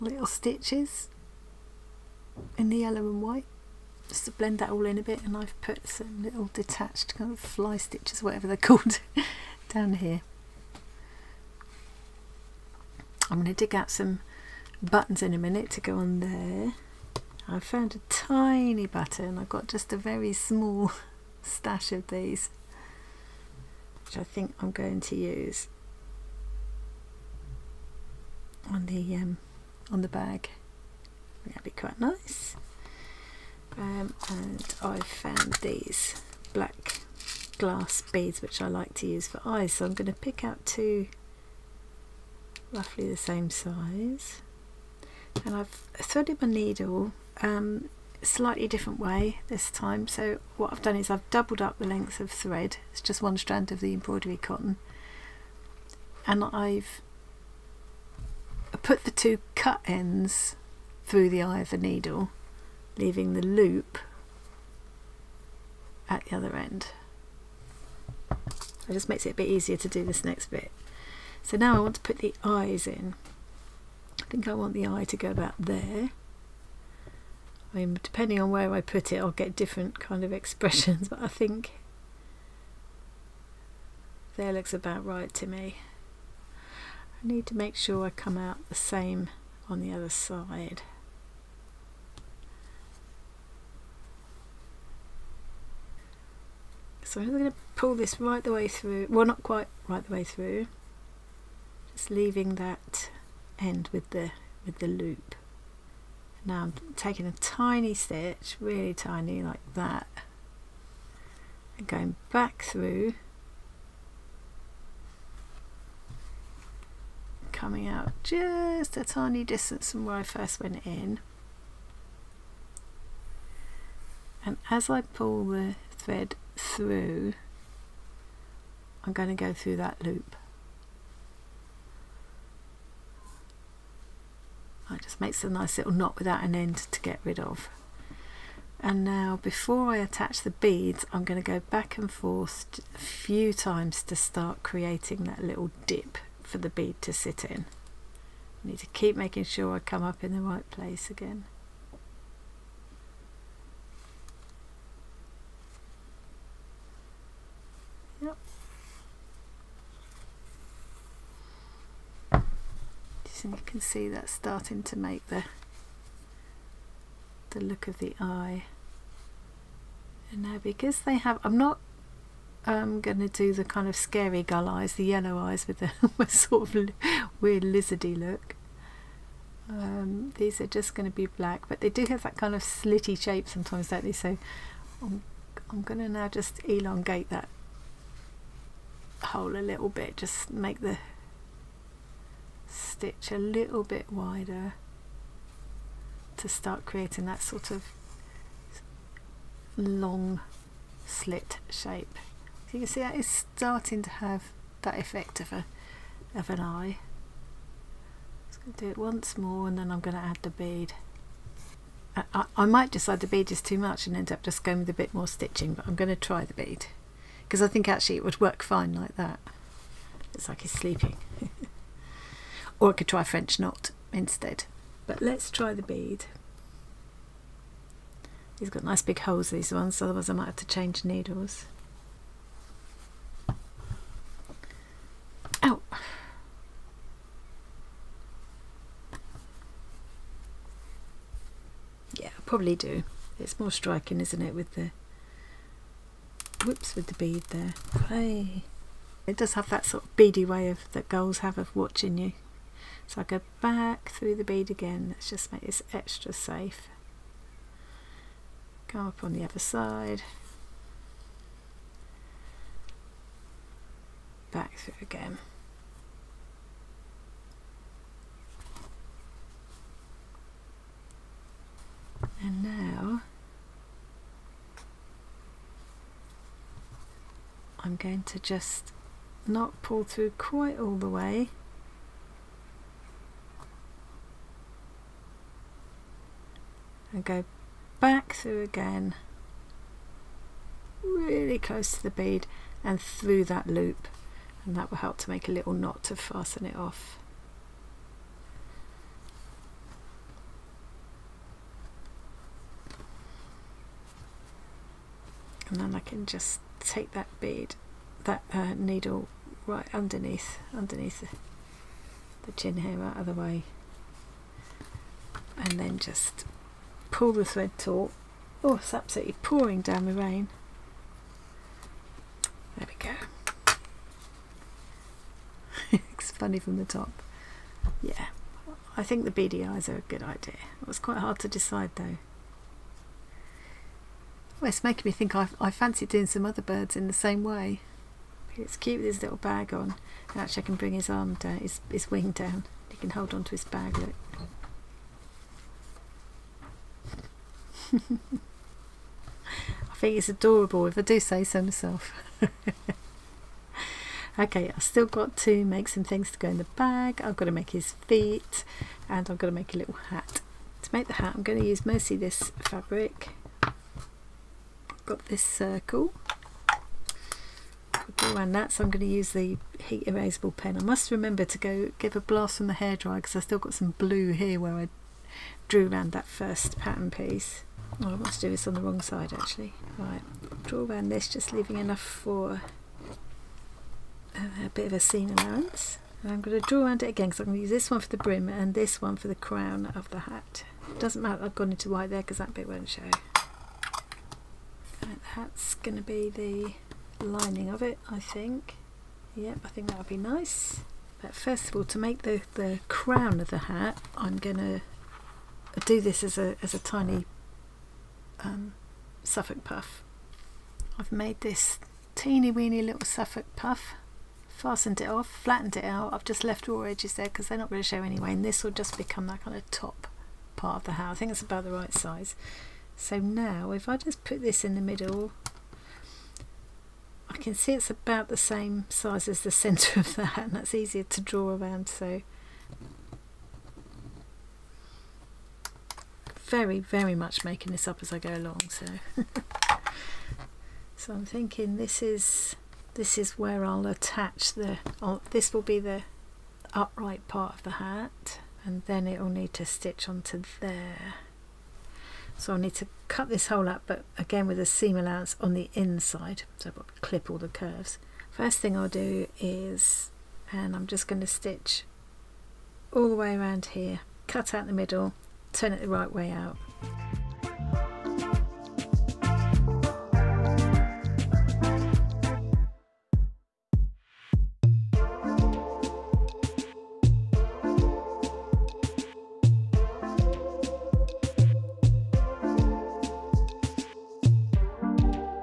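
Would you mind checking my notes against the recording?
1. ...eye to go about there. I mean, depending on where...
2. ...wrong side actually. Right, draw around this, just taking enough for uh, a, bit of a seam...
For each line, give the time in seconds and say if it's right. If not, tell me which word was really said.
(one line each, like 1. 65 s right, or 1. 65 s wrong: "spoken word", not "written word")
1. 74 s right
2. 378 s wrong: "leaving", not "taking".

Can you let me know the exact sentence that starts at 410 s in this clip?
I've made this teeny weeny little Suffolk puff, fastened it off, flattened it out.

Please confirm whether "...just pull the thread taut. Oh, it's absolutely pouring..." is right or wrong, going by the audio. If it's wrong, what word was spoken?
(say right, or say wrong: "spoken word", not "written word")
right.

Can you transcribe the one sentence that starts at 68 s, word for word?
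So it just makes it a bit easier to do this next bit.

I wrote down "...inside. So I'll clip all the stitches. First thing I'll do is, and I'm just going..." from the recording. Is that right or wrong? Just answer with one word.
wrong.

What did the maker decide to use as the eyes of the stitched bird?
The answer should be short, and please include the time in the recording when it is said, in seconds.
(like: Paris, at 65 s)
black glass beads, at 36 s.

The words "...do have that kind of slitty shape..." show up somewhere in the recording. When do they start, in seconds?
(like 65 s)
181 s.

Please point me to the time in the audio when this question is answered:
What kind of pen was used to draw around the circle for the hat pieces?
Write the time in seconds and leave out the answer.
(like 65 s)
369 s.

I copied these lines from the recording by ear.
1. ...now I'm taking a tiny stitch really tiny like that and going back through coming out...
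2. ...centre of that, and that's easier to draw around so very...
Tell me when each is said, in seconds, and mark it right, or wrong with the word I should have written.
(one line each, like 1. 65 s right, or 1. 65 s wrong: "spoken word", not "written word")
1. 106 s right
2. 429 s right.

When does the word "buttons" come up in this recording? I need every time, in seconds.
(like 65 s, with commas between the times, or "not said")
14 s, 18 s.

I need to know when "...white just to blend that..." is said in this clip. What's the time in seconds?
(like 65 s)
3 s.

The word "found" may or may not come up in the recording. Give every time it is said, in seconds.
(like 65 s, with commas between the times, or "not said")
17 s, 35 s.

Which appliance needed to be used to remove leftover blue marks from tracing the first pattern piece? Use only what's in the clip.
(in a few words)
hairdryer.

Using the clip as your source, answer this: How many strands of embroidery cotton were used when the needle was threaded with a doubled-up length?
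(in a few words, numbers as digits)
1.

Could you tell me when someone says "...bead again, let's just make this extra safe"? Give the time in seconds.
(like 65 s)
254 s.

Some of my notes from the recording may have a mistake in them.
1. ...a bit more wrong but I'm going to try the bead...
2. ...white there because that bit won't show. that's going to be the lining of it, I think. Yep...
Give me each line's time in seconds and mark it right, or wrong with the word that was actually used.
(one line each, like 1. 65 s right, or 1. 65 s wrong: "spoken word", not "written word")
1. 214 s wrong: "stitching", not "wrong"
2. 391 s right.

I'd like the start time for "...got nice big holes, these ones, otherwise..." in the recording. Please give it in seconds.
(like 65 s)
228 s.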